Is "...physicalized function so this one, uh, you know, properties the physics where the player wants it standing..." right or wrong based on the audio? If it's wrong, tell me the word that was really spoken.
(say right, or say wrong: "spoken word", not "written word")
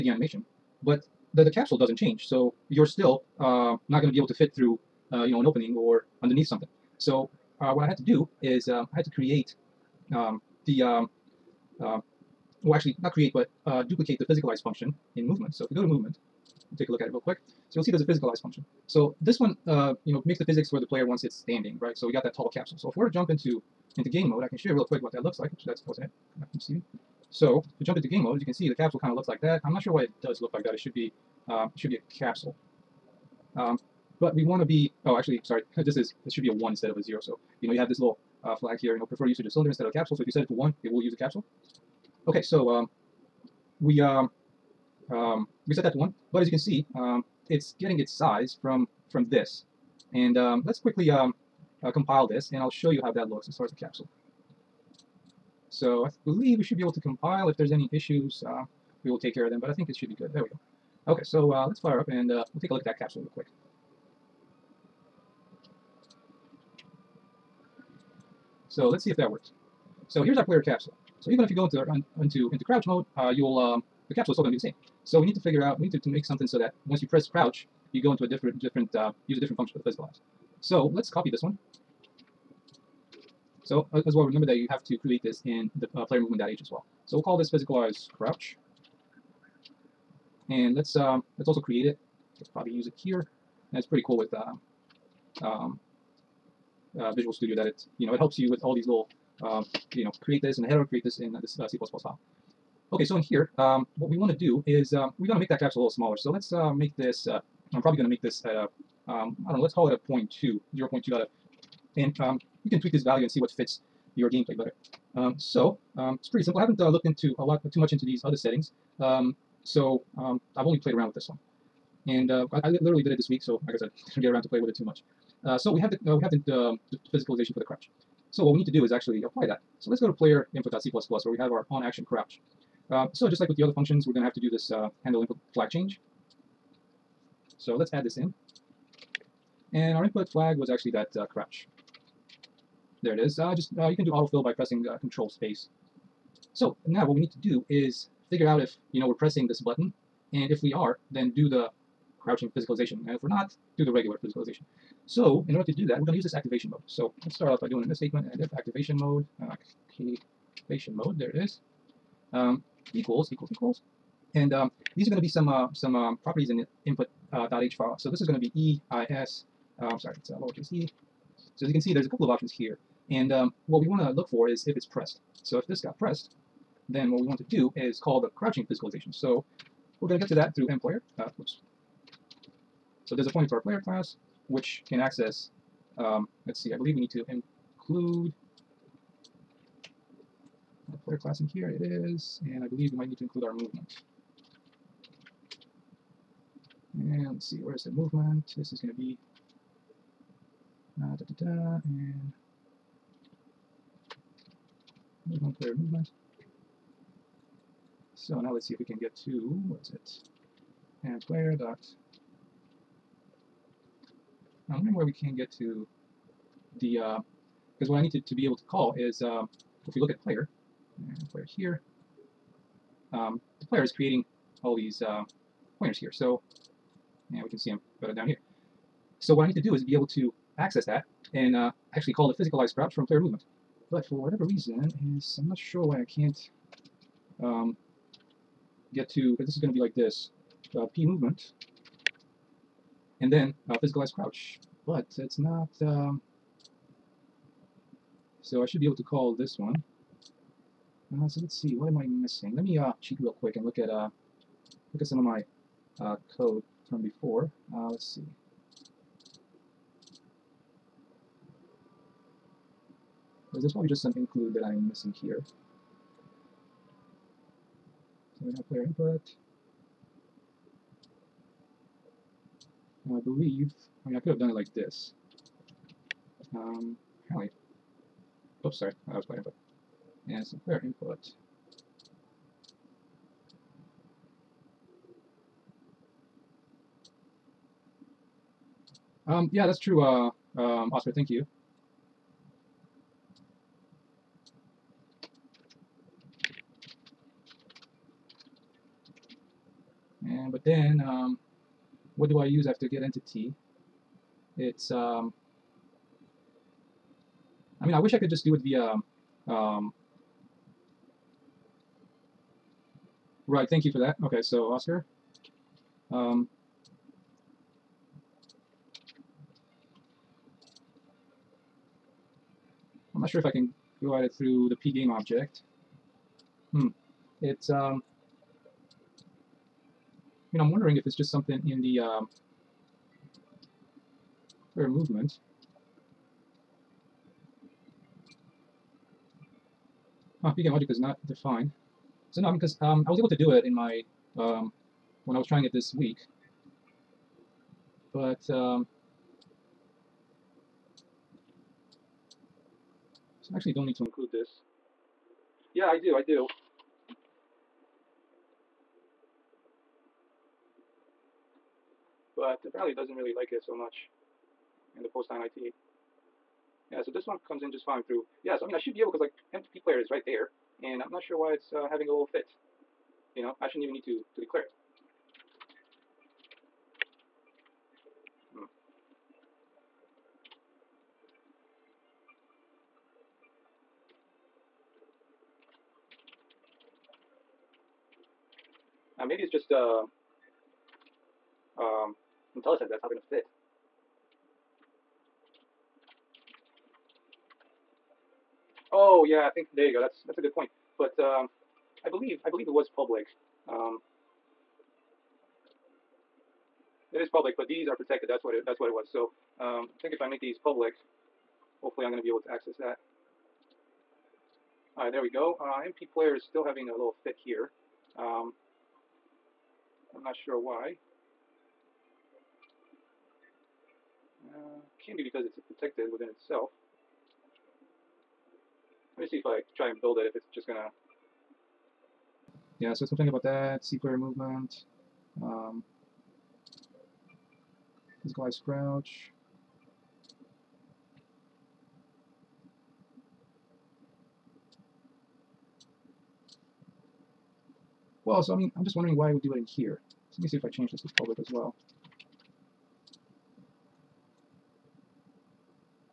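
wrong: "makes", not "properties".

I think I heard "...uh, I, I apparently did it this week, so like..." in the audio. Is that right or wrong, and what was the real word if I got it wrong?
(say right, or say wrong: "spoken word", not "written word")
wrong: "literally", not "apparently".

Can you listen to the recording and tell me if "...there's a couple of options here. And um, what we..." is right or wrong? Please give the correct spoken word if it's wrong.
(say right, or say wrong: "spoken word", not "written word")
right.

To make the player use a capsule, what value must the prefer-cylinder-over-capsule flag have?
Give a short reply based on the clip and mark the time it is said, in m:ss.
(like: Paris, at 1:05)
1, at 0:36.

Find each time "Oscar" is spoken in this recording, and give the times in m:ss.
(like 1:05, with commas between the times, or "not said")
4:50, 5:14.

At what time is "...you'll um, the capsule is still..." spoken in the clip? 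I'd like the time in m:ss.
1:13.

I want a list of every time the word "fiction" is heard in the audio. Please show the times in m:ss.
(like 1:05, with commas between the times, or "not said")
not said.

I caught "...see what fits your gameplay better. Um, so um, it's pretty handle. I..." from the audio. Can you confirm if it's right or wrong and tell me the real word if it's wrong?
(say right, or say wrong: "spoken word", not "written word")
wrong: "simple", not "handle".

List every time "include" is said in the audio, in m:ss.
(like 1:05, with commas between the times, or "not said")
3:07, 3:13, 4:24, 5:54.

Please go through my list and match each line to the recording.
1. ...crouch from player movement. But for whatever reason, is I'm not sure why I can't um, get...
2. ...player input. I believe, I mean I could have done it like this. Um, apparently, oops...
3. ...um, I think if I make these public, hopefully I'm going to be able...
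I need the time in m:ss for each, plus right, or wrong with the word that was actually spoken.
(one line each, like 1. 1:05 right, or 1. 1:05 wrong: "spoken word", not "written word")
1. 3:52 right
2. 4:28 right
3. 6:49 right.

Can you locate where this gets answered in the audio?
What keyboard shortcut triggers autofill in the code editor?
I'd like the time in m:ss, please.
2:25.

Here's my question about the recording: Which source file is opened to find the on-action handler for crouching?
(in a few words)
player input.c++.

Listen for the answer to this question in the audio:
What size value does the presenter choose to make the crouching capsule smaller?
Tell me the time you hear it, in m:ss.
1:50.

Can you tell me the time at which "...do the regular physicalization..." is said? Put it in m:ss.
2:33.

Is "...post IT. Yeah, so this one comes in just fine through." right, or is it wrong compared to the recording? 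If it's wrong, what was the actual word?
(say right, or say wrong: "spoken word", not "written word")
right.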